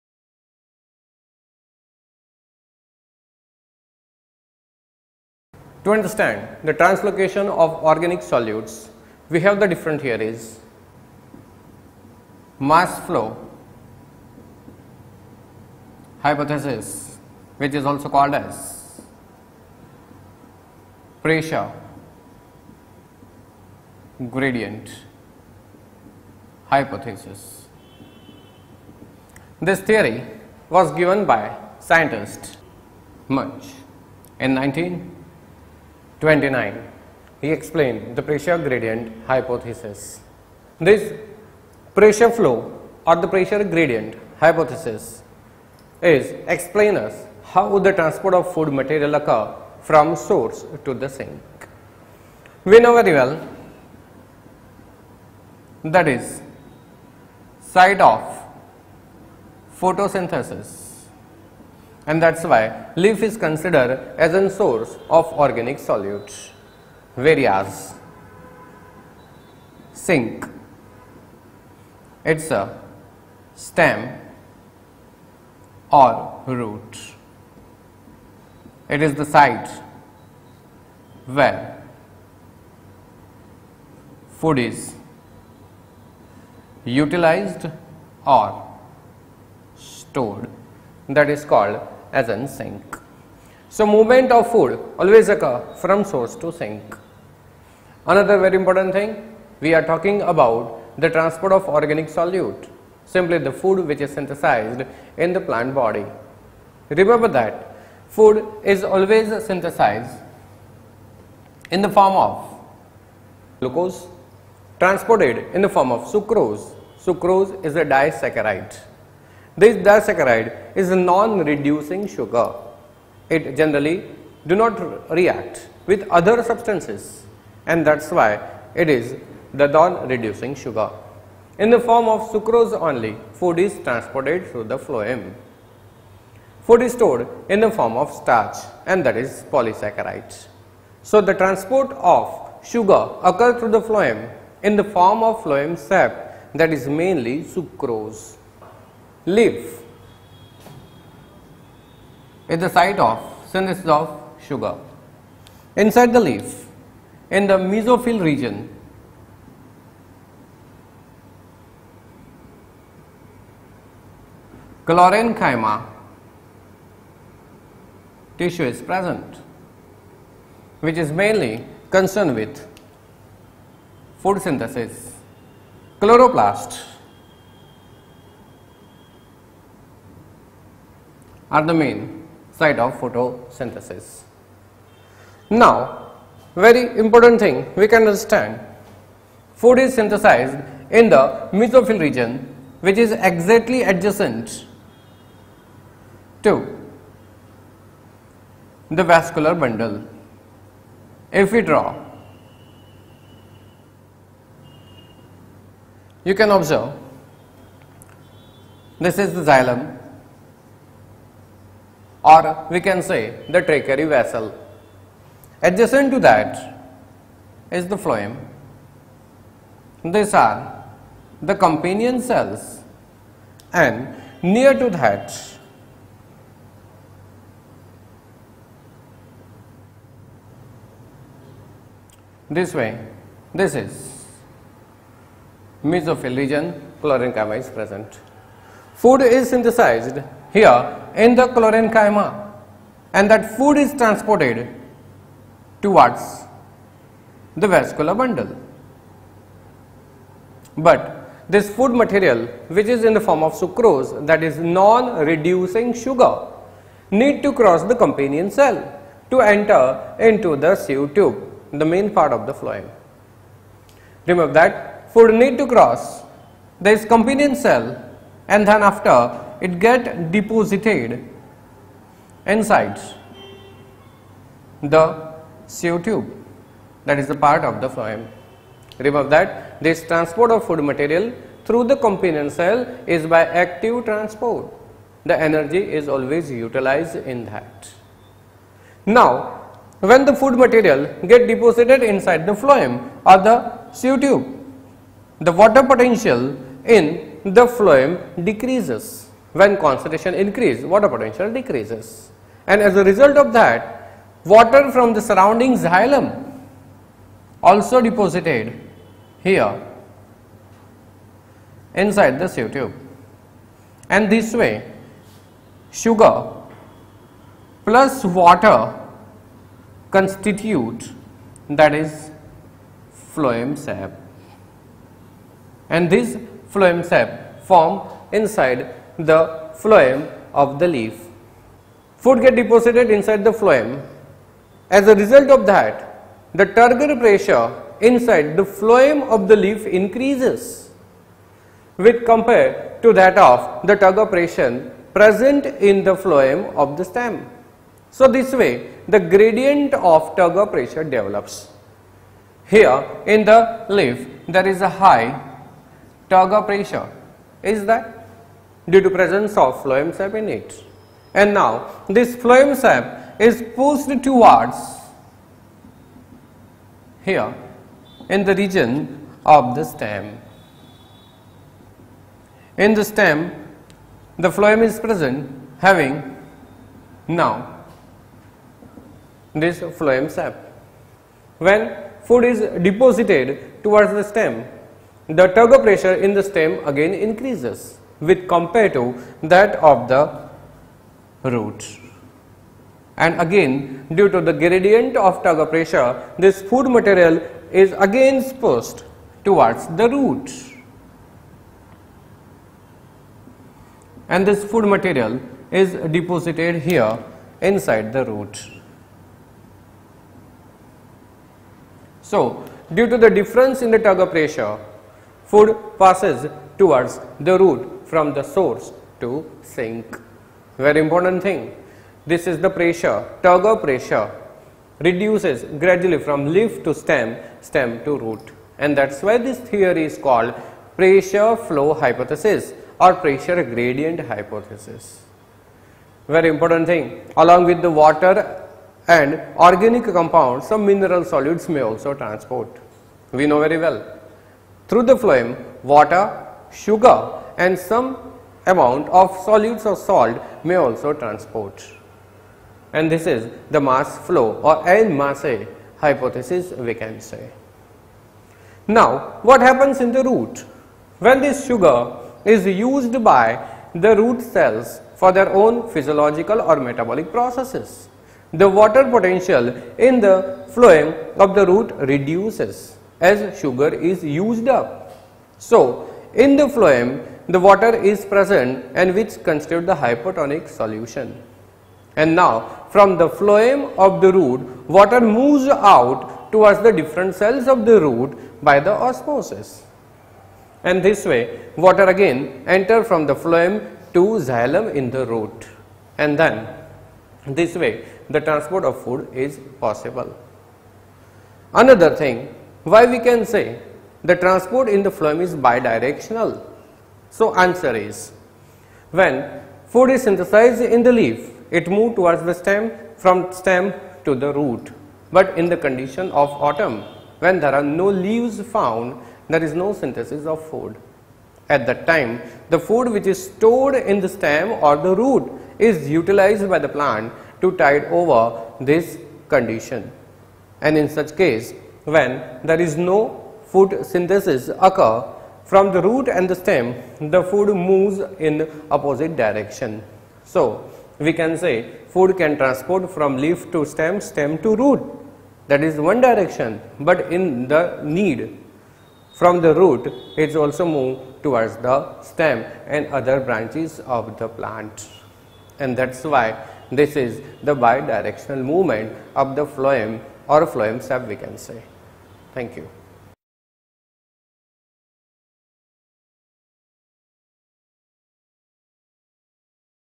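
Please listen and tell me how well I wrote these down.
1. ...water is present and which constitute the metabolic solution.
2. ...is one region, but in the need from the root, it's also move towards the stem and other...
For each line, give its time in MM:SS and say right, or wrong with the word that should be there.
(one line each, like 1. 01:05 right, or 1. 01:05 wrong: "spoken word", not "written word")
1. 07:57 wrong: "hypotonic", not "metabolic"
2. 09:05 wrong: "direction", not "region".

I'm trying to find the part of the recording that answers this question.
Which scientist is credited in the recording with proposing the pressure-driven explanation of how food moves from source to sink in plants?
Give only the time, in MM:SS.
00:33.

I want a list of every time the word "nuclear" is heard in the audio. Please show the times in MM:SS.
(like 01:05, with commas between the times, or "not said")
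not said.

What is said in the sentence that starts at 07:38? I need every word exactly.
Now, what happens in the root?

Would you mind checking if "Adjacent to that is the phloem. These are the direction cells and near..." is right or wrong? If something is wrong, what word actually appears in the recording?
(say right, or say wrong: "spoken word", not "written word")
wrong: "companion", not "direction".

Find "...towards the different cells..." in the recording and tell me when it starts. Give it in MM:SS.
08:06.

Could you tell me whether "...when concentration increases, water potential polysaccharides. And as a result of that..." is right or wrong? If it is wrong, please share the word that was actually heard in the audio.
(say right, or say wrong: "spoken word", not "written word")
wrong: "decreases", not "polysaccharides".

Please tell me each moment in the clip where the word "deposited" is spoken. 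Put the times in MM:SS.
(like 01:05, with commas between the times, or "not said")
04:30, 04:51, 05:08, 05:32, 06:22, 06:46.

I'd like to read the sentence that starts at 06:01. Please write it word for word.
And now this phloem sap is pushed towards here in the region of the stem.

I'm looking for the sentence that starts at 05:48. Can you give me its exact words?
So this way the gradient of turgor pressure develops.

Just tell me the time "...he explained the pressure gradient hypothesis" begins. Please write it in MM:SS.
00:37.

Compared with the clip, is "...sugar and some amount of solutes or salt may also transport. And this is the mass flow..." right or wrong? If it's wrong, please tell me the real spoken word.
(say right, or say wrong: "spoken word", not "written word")
right.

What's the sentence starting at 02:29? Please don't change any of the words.
Leaf is the site of synthesis of sugar.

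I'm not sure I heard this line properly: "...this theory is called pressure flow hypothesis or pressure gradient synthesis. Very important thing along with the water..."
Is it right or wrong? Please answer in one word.
wrong.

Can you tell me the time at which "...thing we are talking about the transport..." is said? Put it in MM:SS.
01:38.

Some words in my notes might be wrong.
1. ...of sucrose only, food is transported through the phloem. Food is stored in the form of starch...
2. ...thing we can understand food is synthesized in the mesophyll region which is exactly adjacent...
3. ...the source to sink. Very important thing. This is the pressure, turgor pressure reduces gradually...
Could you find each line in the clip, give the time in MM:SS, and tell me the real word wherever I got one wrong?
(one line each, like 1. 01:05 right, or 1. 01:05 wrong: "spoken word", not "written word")
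1. 02:12 right
2. 03:07 right
3. 06:58 right.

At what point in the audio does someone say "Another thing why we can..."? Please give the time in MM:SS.
08:21.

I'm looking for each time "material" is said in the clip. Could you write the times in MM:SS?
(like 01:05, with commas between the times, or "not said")
00:48, 04:11, 04:40, 04:50, 06:36, 06:44.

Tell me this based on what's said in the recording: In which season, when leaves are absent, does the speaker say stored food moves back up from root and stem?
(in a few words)
autumn.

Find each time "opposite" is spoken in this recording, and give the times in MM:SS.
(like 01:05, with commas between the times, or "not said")
08:58.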